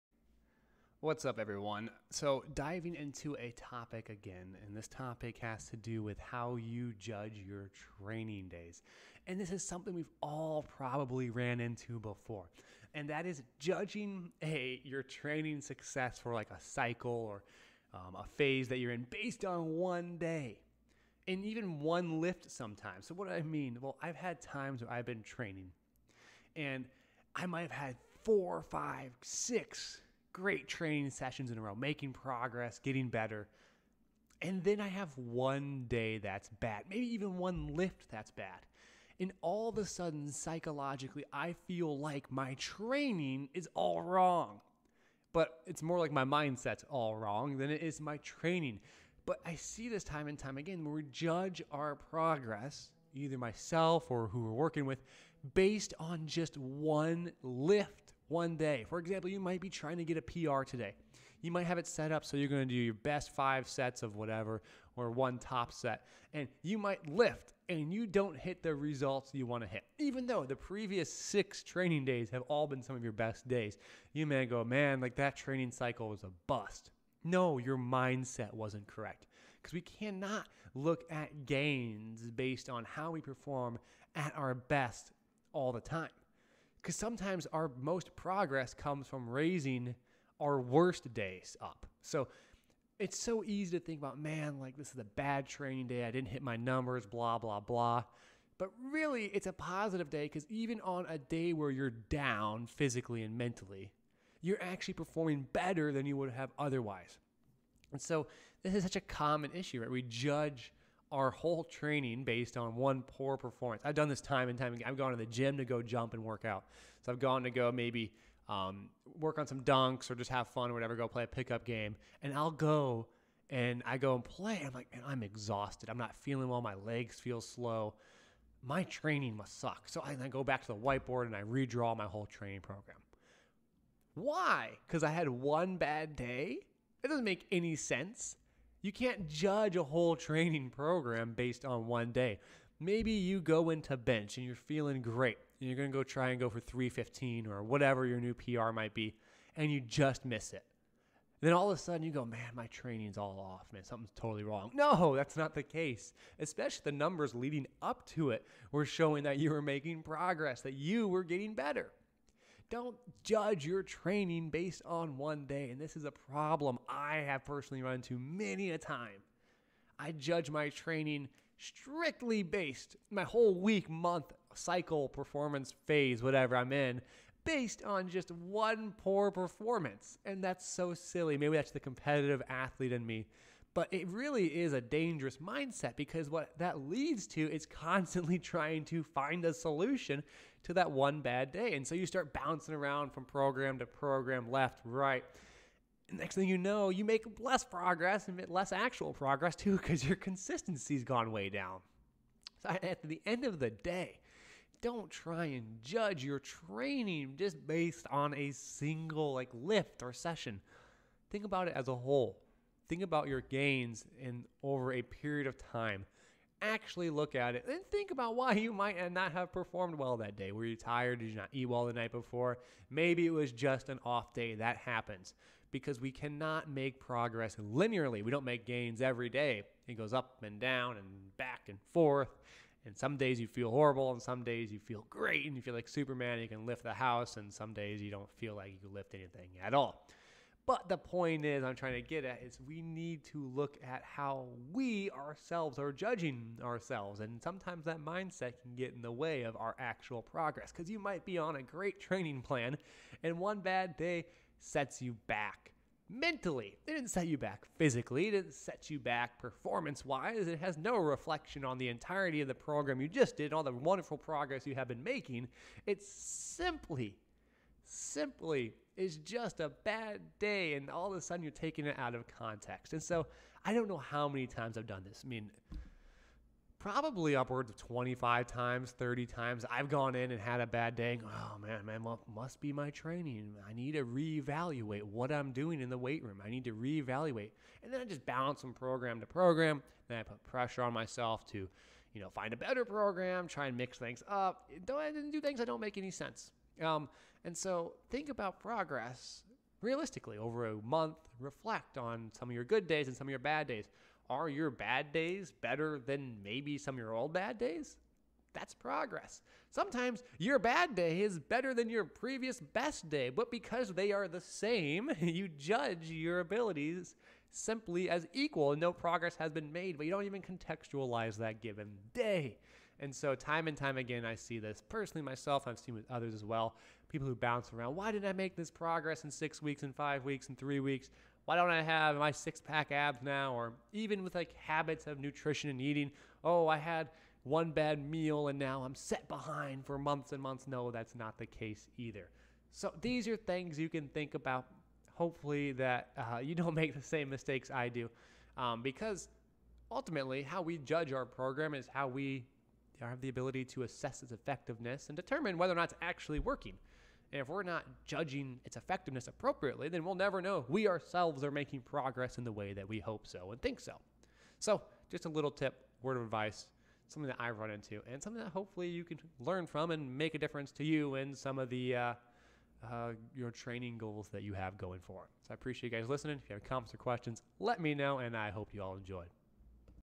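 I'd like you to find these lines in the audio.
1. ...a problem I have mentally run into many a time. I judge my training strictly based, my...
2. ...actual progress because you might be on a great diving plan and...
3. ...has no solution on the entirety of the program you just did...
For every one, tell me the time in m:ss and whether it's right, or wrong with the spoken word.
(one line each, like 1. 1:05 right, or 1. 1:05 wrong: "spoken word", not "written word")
1. 2:46 wrong: "personally", not "mentally"
2. 4:09 wrong: "training", not "diving"
3. 4:20 wrong: "reflection", not "solution".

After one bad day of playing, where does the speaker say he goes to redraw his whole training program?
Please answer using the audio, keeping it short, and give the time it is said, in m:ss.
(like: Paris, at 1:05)
the whiteboard, at 2:10.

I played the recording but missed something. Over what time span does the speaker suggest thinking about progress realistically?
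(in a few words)
a month.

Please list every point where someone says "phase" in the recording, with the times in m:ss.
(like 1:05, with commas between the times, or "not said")
0:18, 2:55.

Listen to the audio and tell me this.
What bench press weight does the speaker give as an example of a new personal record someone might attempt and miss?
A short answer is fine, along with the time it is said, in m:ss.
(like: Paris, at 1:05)
315, at 2:26.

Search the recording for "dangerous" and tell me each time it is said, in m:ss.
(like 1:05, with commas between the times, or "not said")
3:04.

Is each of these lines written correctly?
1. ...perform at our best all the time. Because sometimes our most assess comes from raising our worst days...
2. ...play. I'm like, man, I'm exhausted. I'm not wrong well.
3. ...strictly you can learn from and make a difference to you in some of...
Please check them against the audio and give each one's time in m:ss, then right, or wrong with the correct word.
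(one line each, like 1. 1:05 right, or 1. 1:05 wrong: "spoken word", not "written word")
1. 1:23 wrong: "progress", not "assess"
2. 2:04 wrong: "feeling", not "wrong"
3. 6:08 wrong: "hopefully", not "strictly".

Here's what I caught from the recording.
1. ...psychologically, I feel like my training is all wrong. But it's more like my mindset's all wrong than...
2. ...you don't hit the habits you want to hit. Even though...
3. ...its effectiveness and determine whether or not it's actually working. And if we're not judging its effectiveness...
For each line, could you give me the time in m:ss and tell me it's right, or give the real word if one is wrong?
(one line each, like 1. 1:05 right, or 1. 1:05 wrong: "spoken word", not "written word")
1. 0:40 right
2. 1:07 wrong: "results", not "habits"
3. 5:54 right.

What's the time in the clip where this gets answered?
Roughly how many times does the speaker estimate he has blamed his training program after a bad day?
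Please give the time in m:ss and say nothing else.
4:37.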